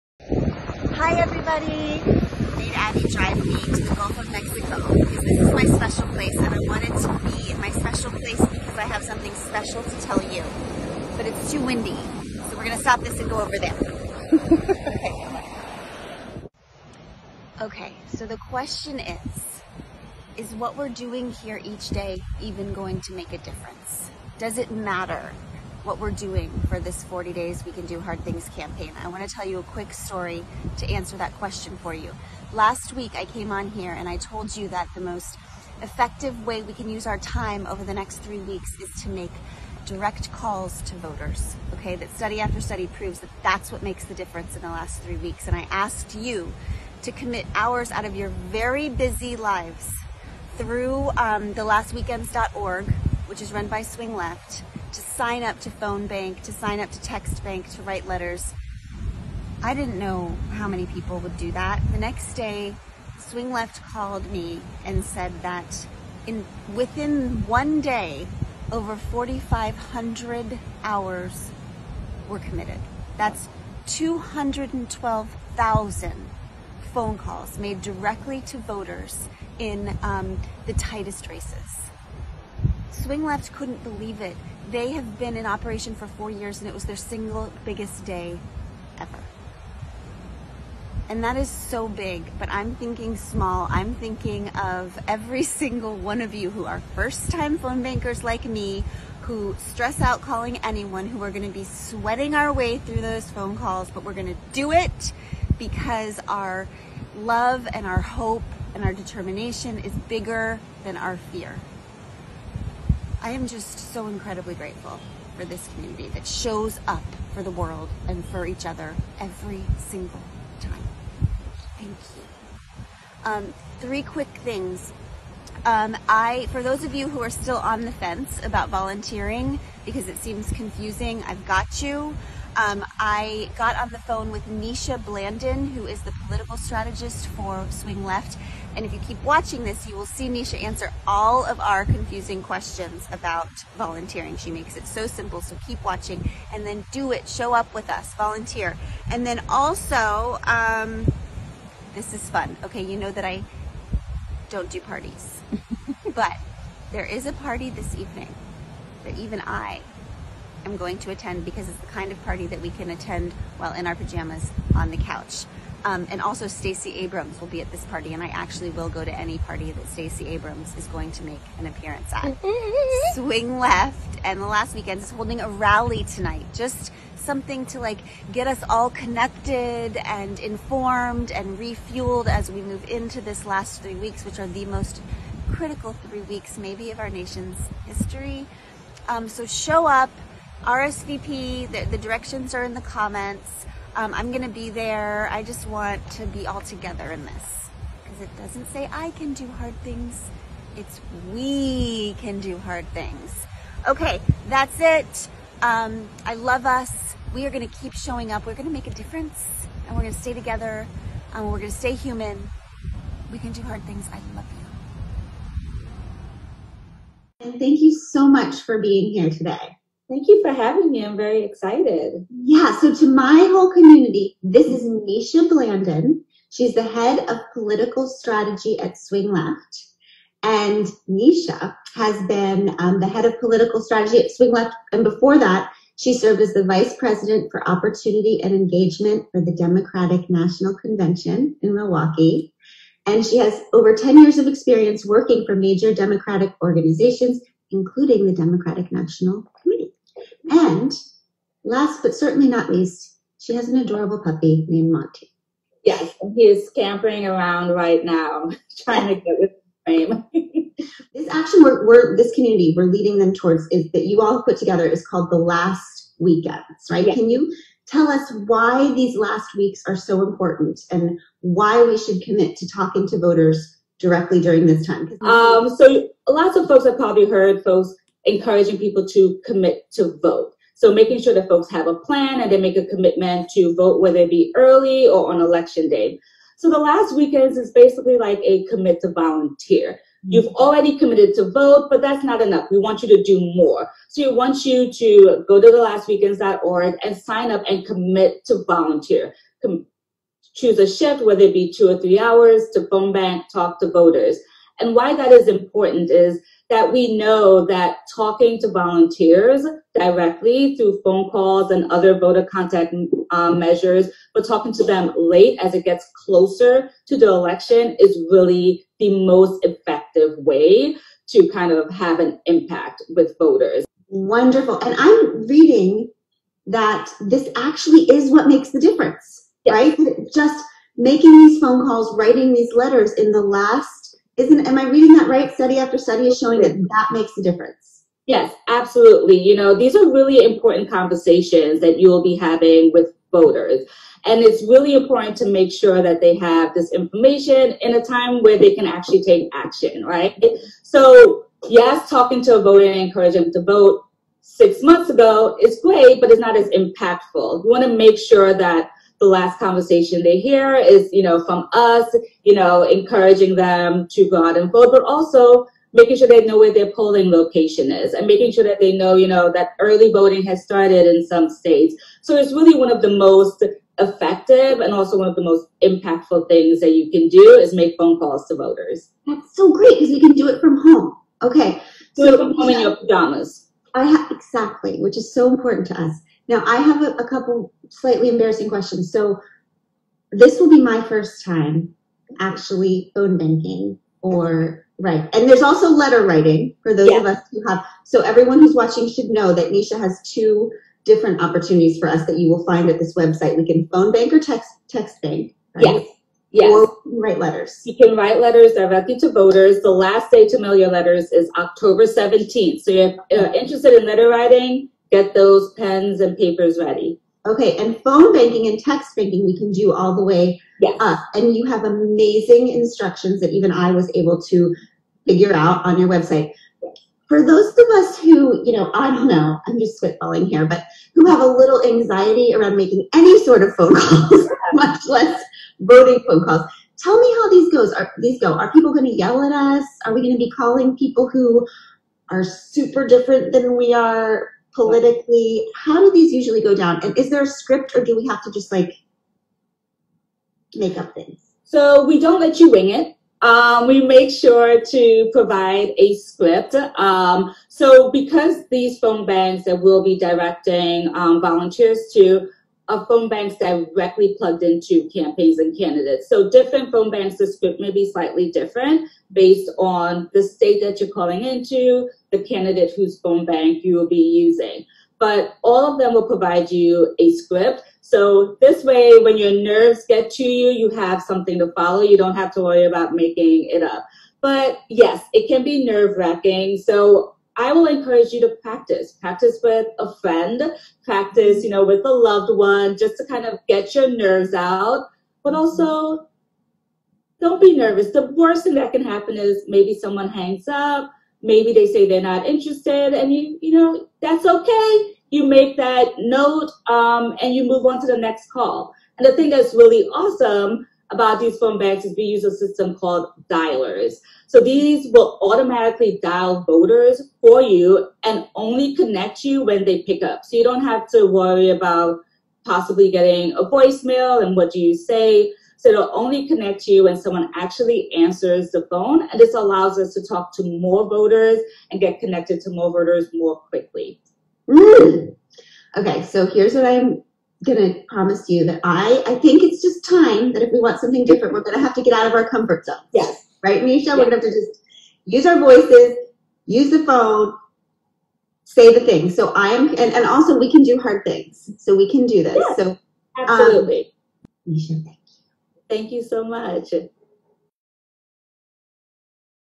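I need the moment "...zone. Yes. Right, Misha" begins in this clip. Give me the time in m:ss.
9:02.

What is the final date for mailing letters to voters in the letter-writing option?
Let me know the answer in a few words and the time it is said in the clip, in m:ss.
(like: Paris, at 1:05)
October 17, at 6:51.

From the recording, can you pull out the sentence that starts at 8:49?
And this allows us to talk to more voters and get connected to more voters more quickly.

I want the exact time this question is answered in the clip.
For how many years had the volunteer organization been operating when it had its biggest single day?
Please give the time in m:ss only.
1:26.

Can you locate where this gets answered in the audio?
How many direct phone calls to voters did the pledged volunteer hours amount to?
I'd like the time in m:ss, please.
1:13.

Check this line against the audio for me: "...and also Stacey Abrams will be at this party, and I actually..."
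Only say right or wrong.
right.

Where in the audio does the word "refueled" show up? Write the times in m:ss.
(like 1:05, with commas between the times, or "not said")
3:01.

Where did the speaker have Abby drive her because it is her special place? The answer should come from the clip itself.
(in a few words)
Gulf of Mexico.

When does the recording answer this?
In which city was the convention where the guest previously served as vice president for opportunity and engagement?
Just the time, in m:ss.
4:01.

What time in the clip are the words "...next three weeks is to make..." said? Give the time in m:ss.
0:37.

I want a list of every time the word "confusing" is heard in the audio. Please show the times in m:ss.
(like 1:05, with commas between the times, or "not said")
2:10, 2:21.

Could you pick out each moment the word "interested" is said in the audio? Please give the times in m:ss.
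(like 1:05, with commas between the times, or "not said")
6:53, 8:22.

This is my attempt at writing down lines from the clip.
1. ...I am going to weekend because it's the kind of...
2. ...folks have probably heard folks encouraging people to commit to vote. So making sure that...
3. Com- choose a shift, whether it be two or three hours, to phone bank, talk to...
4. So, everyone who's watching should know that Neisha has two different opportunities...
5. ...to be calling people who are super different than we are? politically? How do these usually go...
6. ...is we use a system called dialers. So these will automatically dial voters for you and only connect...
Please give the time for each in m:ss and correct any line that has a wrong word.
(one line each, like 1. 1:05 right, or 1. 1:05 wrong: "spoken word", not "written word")
1. 2:39 wrong: "attend", not "weekend"
2. 4:36 right
3. 4:59 right
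4. 6:38 right
5. 7:20 right
6. 8:32 right.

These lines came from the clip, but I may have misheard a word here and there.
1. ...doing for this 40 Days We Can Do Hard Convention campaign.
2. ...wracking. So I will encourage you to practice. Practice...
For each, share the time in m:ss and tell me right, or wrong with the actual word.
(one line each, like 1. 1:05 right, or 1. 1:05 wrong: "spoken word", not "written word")
1. 0:26 wrong: "Things", not "Convention"
2. 8:06 right.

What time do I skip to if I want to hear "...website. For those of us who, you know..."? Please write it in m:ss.
7:06.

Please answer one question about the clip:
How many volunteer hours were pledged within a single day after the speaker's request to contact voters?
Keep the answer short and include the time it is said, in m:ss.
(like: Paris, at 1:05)
4,500, at 1:08.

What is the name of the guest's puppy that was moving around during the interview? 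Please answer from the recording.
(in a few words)
Monty.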